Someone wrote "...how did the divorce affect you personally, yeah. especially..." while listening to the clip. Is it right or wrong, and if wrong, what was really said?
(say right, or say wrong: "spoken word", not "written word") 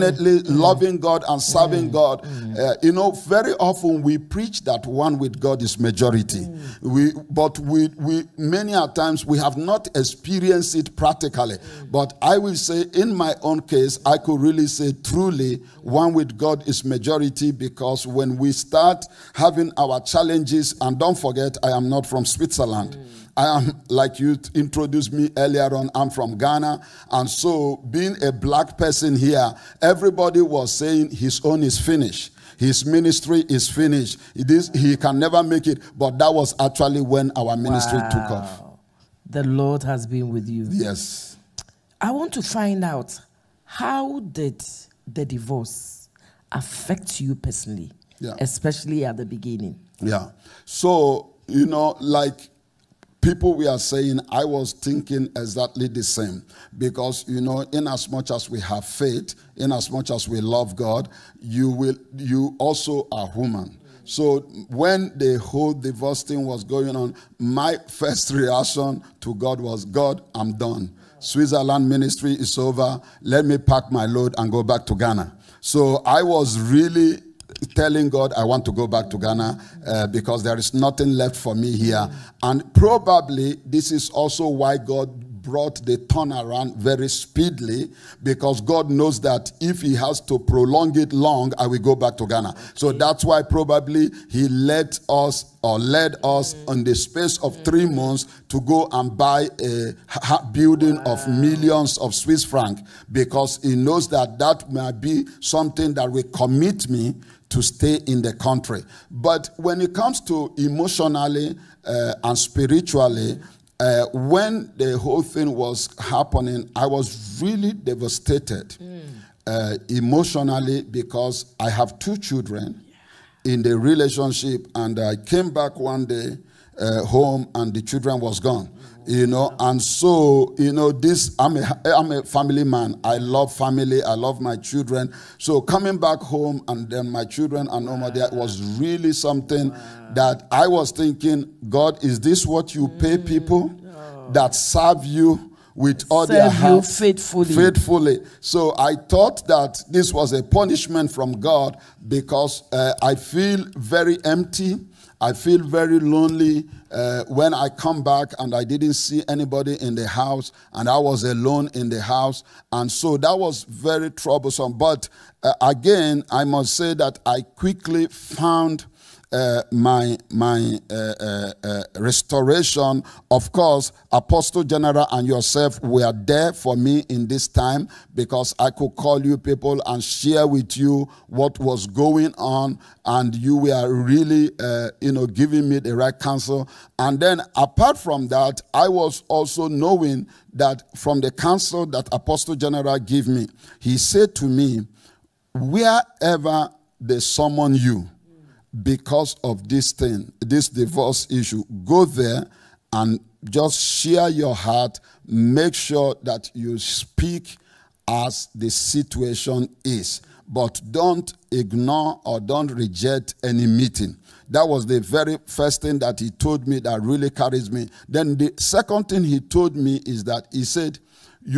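right.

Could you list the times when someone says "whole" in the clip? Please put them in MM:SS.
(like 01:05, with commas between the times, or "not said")
01:05, 01:54.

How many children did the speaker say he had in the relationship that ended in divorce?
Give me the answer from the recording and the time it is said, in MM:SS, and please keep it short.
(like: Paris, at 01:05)
2, at 02:01.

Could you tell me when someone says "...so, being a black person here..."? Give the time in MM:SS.
00:27.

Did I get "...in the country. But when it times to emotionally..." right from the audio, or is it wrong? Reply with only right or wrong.
wrong.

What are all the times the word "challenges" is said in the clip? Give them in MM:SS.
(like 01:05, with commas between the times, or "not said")
00:19.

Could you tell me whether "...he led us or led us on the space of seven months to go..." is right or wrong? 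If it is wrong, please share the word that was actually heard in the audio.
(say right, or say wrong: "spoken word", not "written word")
wrong: "three", not "seven".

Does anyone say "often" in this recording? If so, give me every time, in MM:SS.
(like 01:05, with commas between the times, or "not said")
00:03.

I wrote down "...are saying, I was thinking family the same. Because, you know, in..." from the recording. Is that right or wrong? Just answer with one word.
wrong.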